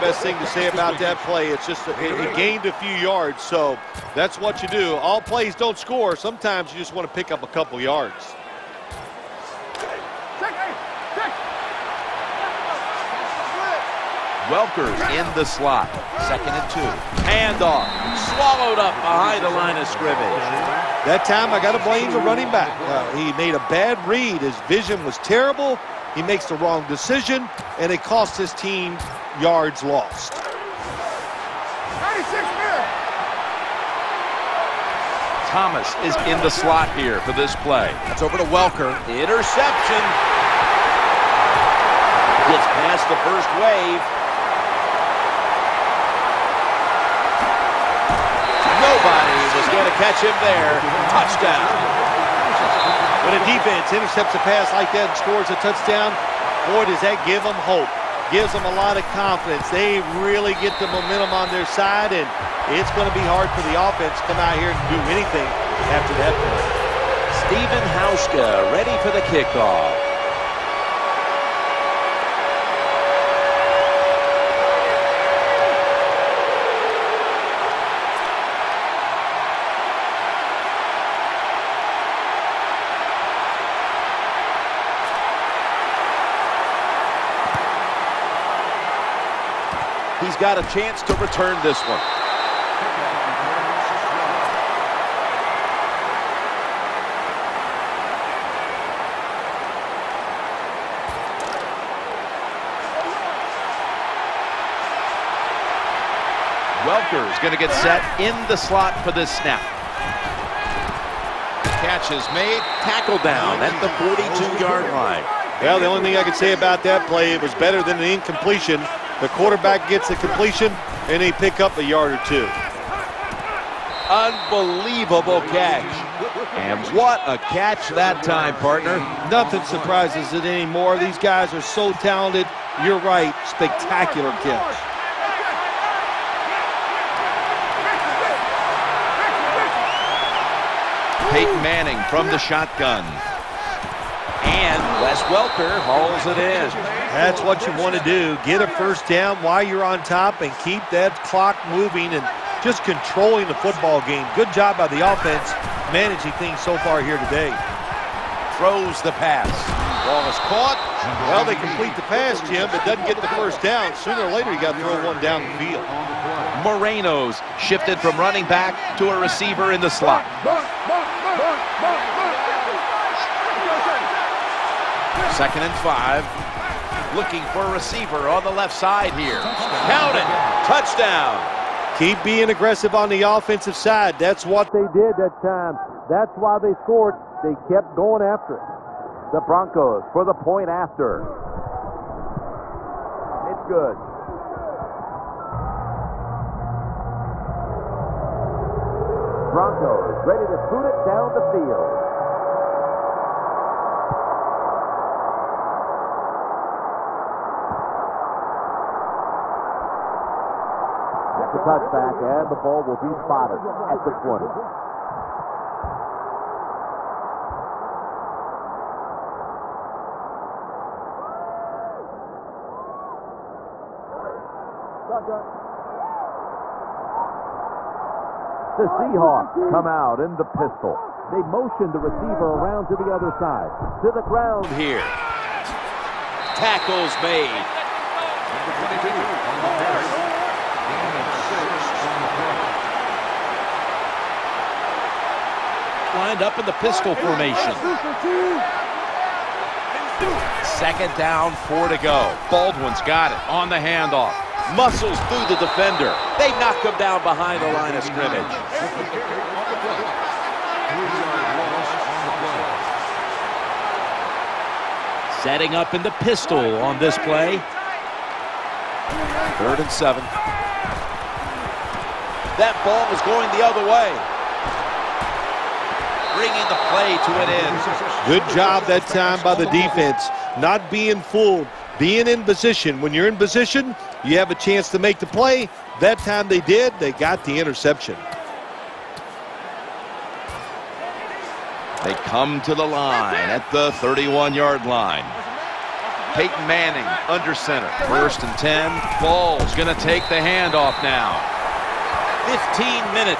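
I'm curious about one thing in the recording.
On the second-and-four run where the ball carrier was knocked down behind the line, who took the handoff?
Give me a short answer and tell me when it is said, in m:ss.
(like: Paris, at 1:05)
Baldwin, at 4:12.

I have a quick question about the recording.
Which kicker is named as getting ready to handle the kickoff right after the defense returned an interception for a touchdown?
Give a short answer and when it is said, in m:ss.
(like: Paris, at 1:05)
Steven Hauschka, at 1:07.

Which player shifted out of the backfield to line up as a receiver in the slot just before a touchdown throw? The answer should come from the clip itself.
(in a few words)
Moreno.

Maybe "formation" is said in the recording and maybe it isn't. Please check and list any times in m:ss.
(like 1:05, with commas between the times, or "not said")
4:07.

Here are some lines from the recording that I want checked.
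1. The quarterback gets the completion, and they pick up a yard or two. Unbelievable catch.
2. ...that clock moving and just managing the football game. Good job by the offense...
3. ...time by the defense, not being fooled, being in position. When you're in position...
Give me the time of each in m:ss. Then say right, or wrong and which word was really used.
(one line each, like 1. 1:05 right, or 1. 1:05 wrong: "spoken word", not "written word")
1. 1:59 right
2. 2:30 wrong: "controlling", not "managing"
3. 4:39 right.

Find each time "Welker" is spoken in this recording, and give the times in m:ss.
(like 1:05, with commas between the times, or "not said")
0:14, 0:38, 1:46, 2:25.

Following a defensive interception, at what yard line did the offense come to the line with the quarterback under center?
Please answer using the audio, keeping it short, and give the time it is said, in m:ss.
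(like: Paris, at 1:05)
31, at 4:54.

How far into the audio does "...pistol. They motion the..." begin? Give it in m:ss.
3:50.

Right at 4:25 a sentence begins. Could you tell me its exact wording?
Setting up in the pistol on this play.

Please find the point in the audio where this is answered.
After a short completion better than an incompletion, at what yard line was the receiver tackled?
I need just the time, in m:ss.
1:54.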